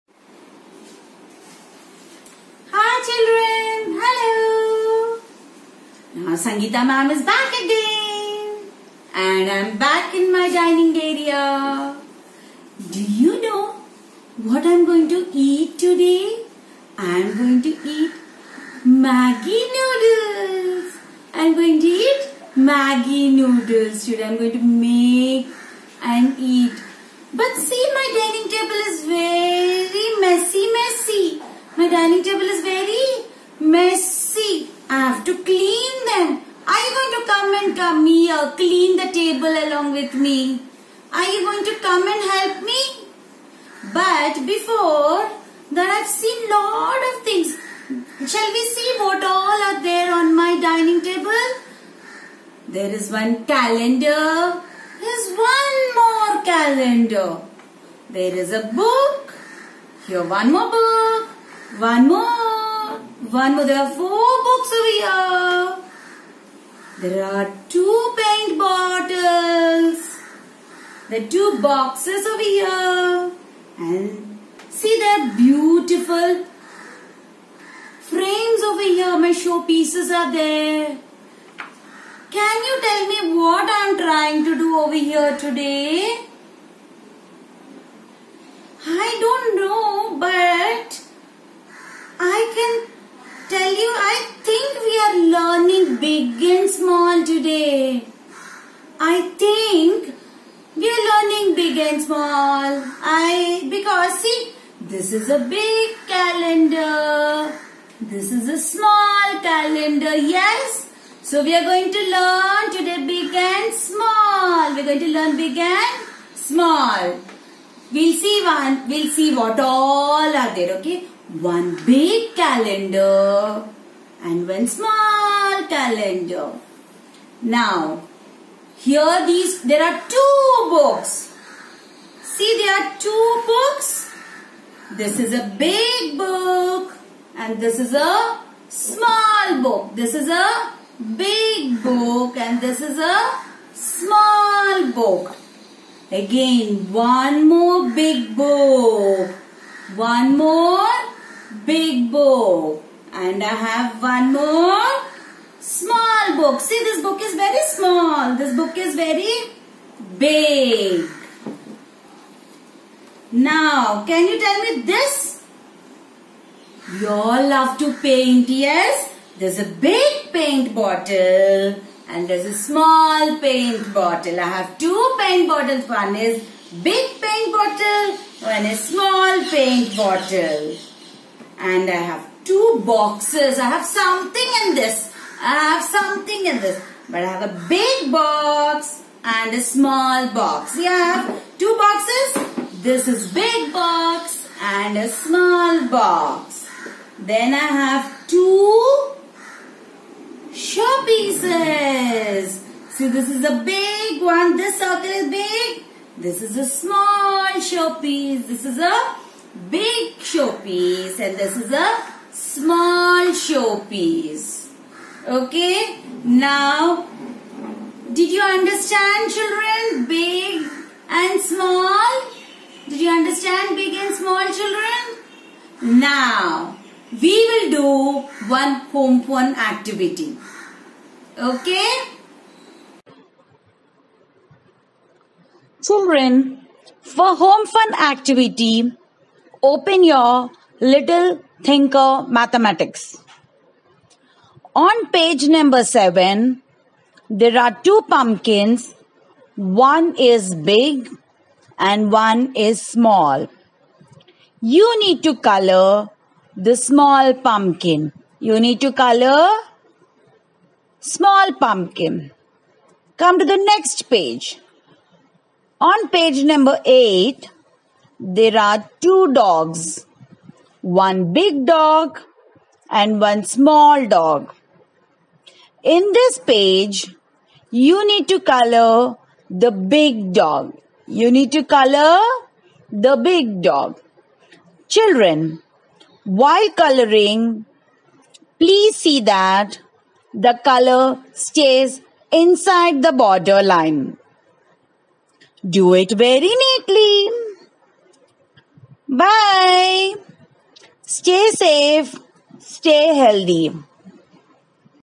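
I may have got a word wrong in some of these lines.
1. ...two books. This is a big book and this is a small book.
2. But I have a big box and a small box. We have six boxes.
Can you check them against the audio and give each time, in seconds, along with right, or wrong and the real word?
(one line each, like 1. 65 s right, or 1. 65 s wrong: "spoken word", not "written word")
1. 133 s right
2. 187 s wrong: "two", not "six".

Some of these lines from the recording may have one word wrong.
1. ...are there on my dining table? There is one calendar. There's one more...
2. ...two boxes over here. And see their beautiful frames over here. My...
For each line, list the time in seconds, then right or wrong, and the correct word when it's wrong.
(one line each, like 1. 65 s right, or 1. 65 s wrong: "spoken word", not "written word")
1. 49 s right
2. 71 s right.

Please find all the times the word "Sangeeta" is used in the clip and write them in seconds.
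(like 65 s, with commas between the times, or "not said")
6 s.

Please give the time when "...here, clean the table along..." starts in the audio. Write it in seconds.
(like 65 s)
38 s.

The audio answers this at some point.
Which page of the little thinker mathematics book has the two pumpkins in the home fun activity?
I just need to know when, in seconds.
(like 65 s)
245 s.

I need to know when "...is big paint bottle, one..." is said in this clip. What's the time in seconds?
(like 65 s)
176 s.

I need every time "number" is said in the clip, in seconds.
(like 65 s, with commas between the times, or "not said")
245 s, 266 s.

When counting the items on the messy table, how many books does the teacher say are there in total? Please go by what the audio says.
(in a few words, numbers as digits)
4.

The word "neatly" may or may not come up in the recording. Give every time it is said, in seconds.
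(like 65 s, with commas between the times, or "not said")
296 s.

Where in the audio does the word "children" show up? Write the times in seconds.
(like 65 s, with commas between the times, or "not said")
219 s, 224 s, 235 s, 284 s.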